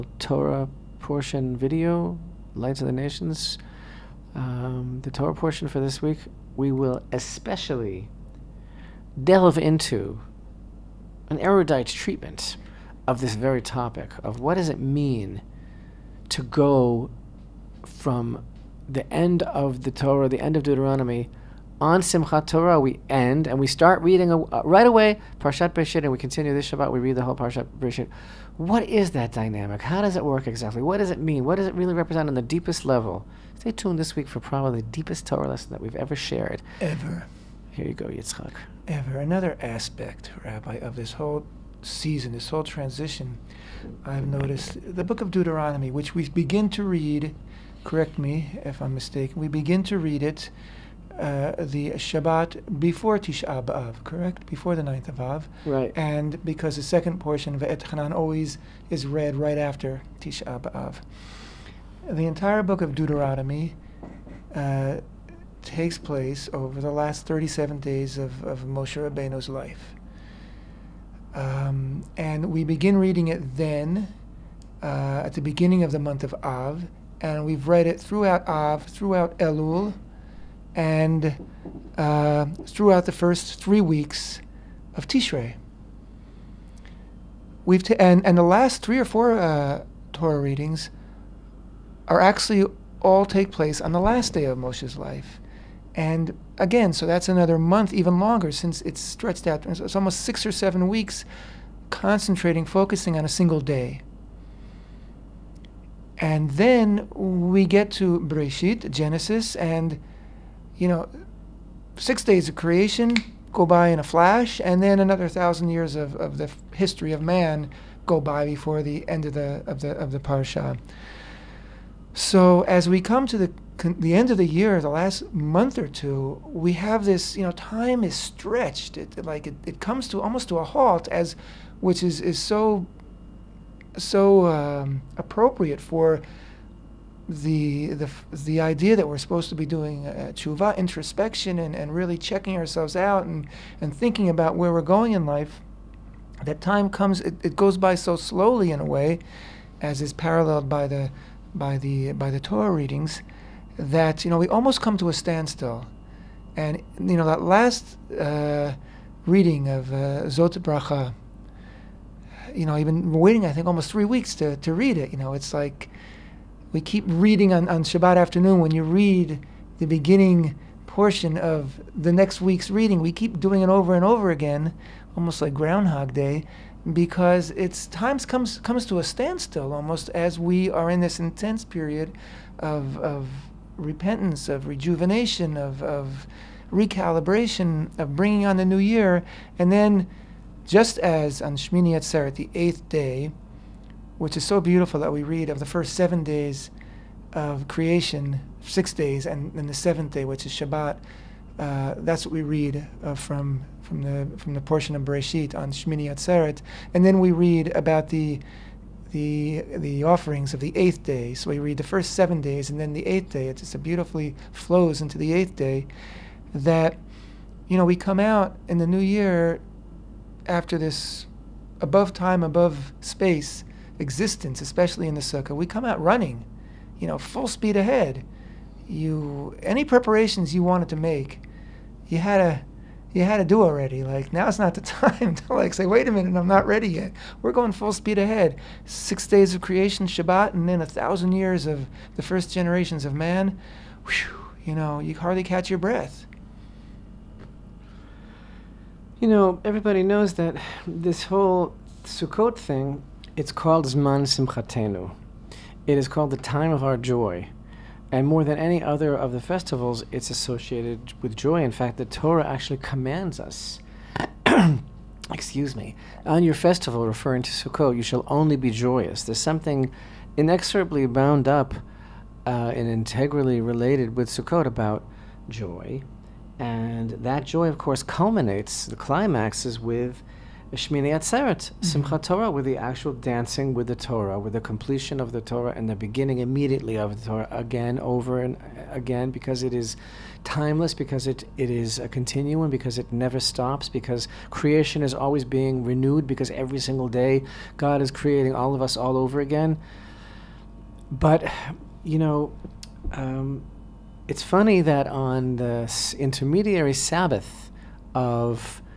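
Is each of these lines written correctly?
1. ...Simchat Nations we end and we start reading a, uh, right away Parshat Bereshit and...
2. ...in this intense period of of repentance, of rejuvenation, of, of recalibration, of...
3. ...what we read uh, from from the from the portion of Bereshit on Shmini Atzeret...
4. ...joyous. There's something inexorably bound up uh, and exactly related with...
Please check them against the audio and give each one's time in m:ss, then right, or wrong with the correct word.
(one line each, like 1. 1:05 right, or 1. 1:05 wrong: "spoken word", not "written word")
1. 0:21 wrong: "Torah", not "Nations"
2. 3:00 right
3. 3:22 right
4. 4:28 wrong: "integrally", not "exactly".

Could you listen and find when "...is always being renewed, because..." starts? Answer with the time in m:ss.
4:55.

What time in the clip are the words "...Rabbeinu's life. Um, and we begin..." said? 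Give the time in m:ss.
1:08.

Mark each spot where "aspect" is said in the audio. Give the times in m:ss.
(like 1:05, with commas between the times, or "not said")
0:39.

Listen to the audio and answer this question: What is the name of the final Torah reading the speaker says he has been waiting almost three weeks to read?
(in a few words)
Zot Bracha.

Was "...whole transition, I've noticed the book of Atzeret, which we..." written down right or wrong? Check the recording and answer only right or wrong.
wrong.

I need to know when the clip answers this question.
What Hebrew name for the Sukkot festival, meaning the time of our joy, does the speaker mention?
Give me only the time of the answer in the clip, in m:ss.
4:13.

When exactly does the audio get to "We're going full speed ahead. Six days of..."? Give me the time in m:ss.
3:57.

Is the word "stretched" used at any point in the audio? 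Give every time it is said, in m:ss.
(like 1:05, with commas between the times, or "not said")
1:38, 2:08.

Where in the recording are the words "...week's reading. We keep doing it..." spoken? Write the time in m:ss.
2:52.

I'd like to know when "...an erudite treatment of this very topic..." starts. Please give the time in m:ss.
0:11.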